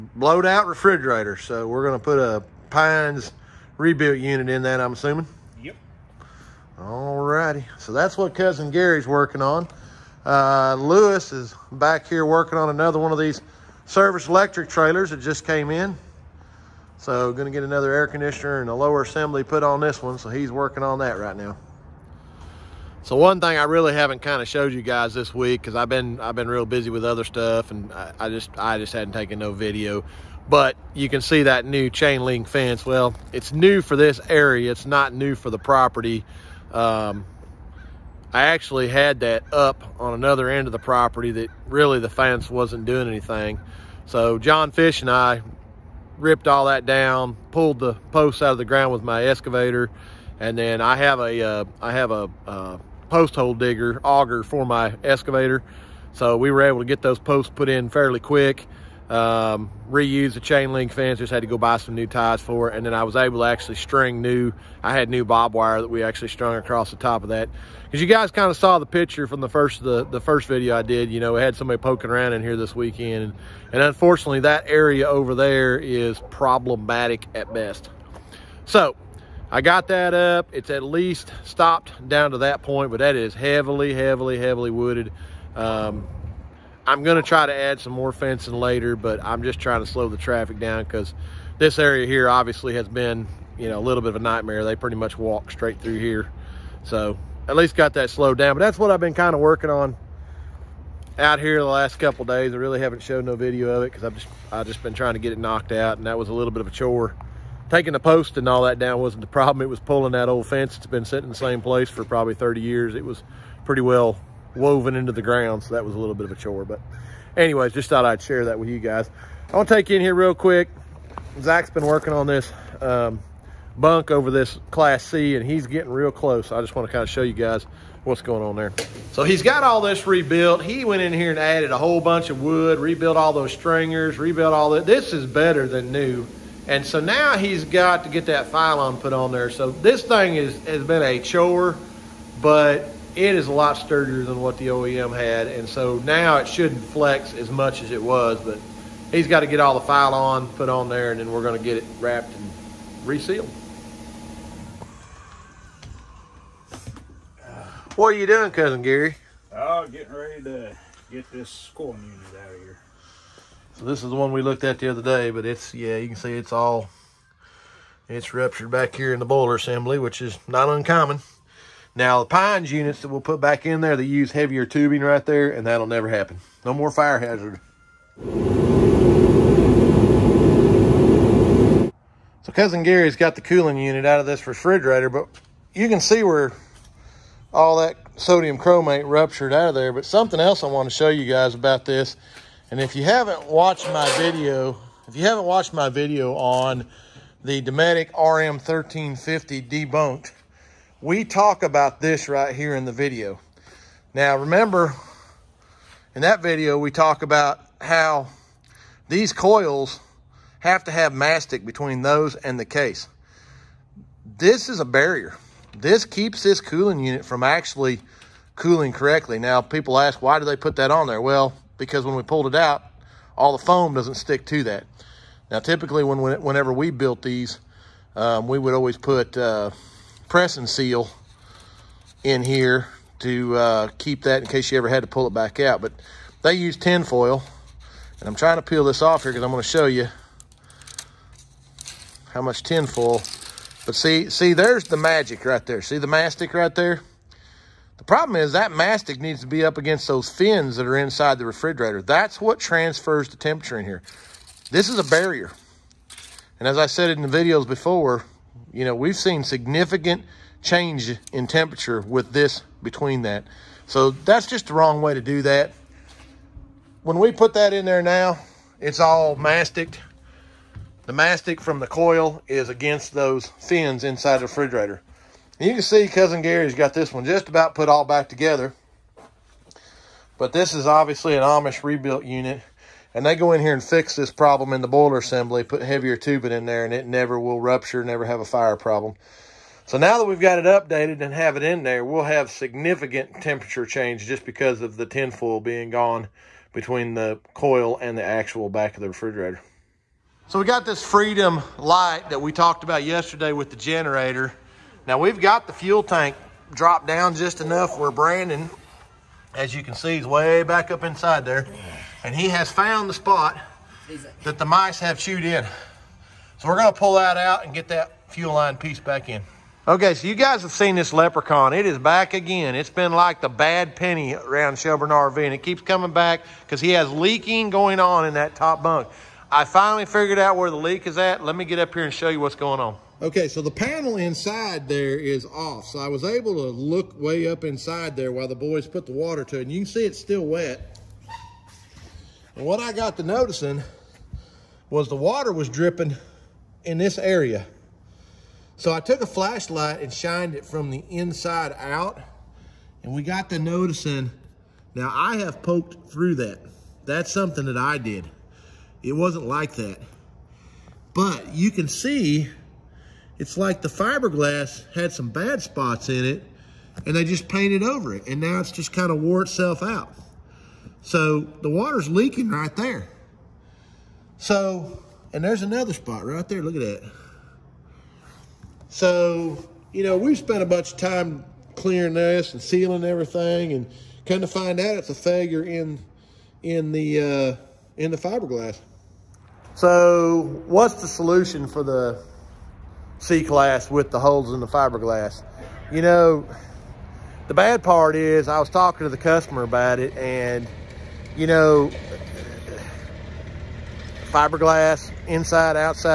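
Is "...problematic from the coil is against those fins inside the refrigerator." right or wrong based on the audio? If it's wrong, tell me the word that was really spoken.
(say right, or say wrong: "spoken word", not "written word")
wrong: "mastic", not "problematic".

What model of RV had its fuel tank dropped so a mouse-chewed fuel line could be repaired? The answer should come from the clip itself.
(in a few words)
Freedom Elite.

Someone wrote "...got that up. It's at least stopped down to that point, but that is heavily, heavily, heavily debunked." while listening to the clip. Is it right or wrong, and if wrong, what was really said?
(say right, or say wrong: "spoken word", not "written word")
wrong: "wooded", not "debunked".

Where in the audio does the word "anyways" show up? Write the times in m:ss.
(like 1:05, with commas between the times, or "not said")
1:57.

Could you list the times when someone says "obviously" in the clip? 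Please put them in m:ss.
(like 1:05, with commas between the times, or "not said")
1:32, 4:40.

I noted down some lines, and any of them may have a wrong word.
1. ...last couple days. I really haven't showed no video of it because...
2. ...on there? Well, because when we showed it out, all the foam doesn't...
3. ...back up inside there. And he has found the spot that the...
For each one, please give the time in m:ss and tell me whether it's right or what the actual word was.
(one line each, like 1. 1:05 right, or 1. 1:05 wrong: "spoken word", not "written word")
1. 1:41 right
2. 3:40 wrong: "pulled", not "showed"
3. 5:10 right.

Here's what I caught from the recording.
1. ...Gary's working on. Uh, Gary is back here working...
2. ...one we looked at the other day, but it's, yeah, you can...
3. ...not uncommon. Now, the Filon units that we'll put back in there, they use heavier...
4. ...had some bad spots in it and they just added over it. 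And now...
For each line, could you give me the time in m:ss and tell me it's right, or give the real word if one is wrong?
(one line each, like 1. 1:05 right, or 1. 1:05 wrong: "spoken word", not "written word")
1. 0:08 wrong: "Lewis", not "Gary"
2. 2:44 right
3. 2:50 wrong: "Pines", not "Filon"
4. 6:04 wrong: "painted", not "added".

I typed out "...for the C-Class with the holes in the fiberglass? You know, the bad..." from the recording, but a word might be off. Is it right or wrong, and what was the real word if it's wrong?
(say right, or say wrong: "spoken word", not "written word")
right.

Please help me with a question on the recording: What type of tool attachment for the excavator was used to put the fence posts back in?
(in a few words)
Post hole digger auger.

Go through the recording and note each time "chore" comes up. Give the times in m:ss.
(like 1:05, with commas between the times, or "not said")
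1:46, 1:56, 2:21.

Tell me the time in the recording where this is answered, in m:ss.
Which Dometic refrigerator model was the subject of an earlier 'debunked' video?
3:18.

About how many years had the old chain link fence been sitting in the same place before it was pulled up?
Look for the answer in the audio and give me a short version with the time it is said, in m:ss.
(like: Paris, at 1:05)
30, at 1:52.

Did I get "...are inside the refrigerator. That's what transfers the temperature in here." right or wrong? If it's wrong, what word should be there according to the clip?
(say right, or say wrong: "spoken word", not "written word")
right.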